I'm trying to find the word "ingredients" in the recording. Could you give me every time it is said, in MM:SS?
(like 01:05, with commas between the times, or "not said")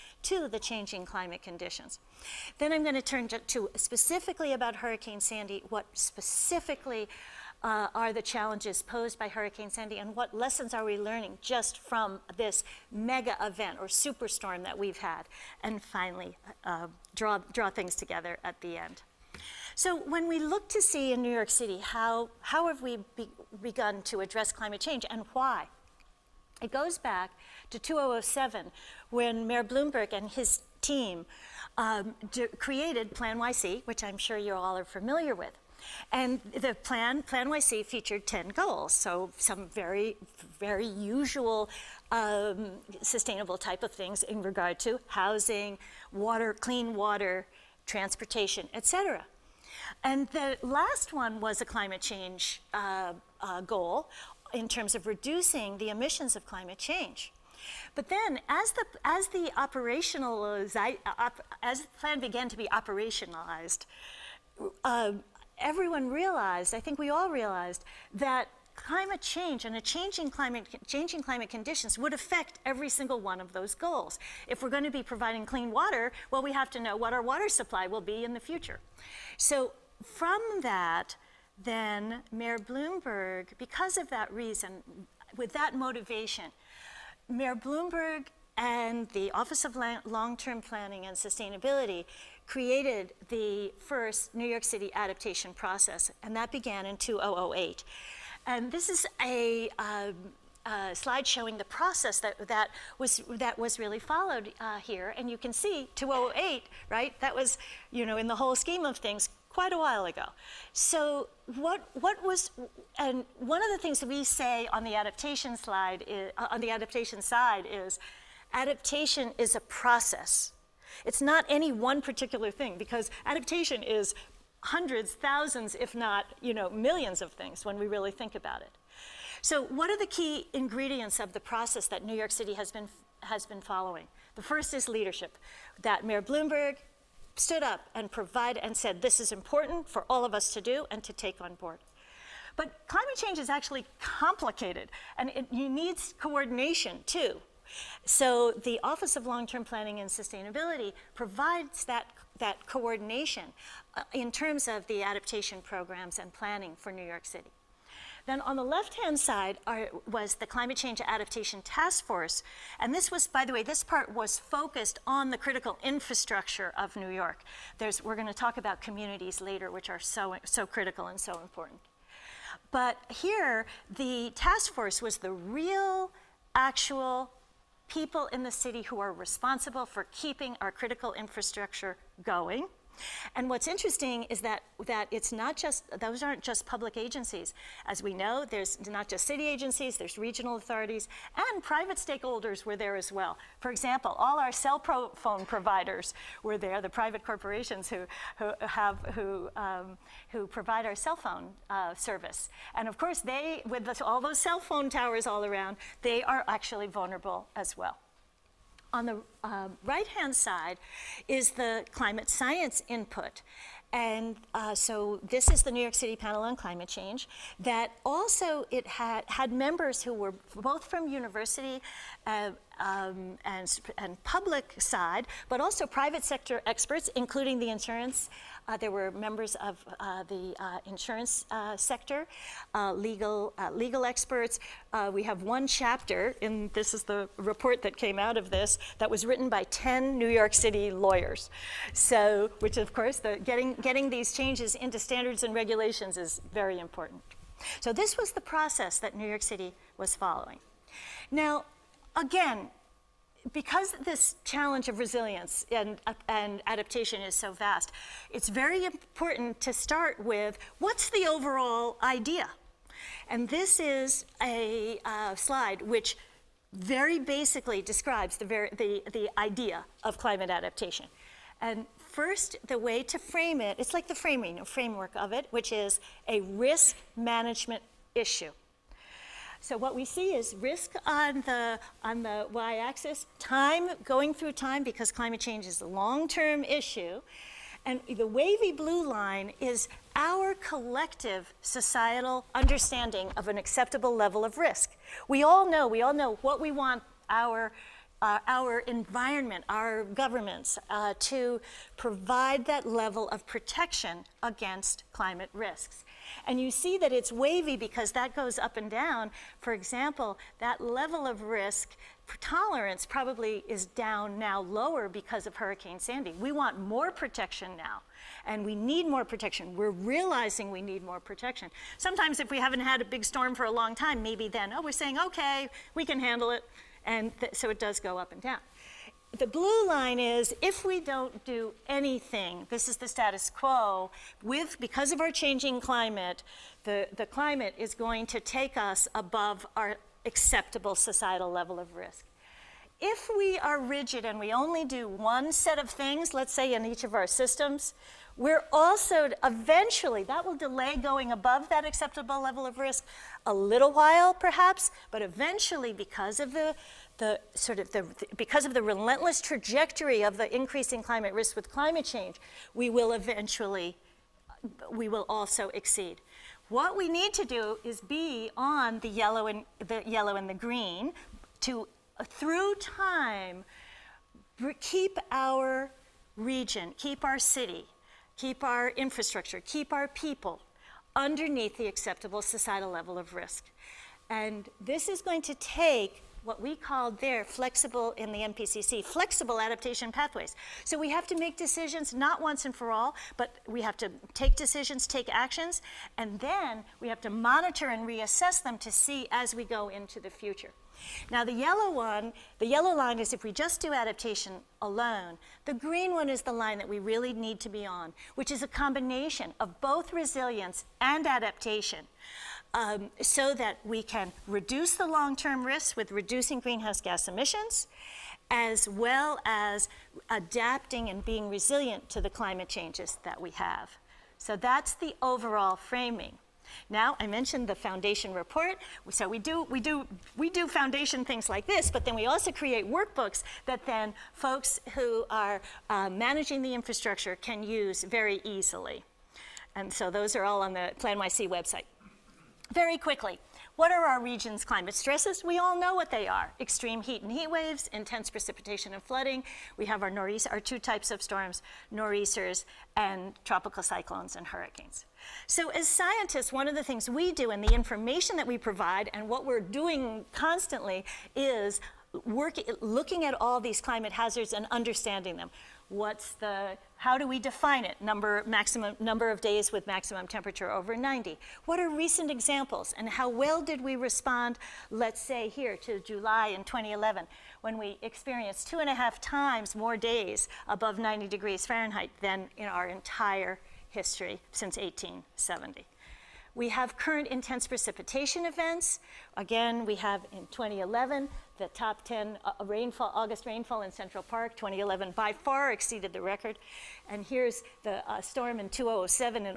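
02:10.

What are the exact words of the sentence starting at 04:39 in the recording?
So what we see is risk on the, on the y-axis, time going through time because climate change is a long-term issue.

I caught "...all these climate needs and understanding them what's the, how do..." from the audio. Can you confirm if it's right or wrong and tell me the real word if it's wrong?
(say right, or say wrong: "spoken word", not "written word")
wrong: "hazards", not "needs".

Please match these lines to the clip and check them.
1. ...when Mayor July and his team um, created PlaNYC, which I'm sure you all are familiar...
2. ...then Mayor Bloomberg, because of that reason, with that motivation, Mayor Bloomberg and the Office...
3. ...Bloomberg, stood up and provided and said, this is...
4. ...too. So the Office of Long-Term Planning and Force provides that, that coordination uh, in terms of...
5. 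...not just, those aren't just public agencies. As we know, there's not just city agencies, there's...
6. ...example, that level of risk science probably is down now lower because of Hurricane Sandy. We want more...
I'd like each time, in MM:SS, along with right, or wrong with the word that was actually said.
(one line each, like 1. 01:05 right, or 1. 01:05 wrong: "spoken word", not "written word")
1. 00:29 wrong: "Bloomberg", not "July"
2. 01:21 right
3. 02:16 right
4. 02:27 wrong: "Sustainability", not "Force"
5. 03:05 right
6. 05:09 wrong: "tolerance", not "science".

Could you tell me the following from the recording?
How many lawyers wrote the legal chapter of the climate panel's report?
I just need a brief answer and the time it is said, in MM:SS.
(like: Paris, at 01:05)
ten, at 03:59.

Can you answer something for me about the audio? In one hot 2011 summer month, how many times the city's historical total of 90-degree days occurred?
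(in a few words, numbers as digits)
two and a half.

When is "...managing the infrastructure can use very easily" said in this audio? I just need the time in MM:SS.
07:16.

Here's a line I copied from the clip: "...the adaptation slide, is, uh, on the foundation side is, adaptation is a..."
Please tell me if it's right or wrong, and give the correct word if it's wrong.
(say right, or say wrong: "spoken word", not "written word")
wrong: "adaptation", not "foundation".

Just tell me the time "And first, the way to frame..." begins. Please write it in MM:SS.
04:31.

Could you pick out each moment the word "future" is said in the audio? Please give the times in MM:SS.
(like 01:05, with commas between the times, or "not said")
01:18, 06:40.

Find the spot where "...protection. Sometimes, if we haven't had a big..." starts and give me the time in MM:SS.
05:21.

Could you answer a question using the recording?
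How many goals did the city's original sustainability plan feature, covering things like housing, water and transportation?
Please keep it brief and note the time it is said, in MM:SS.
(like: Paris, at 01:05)
10, at 00:38.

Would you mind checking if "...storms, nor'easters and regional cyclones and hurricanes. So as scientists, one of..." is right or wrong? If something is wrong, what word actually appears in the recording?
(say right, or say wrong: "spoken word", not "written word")
wrong: "tropical", not "regional".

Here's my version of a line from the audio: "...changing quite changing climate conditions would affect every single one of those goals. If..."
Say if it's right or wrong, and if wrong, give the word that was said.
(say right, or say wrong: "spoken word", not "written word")
wrong: "climate", not "quite".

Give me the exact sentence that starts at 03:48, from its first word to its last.
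Uh, there were members of uh, the uh, insurance uh, sector, uh, legal uh, legal experts.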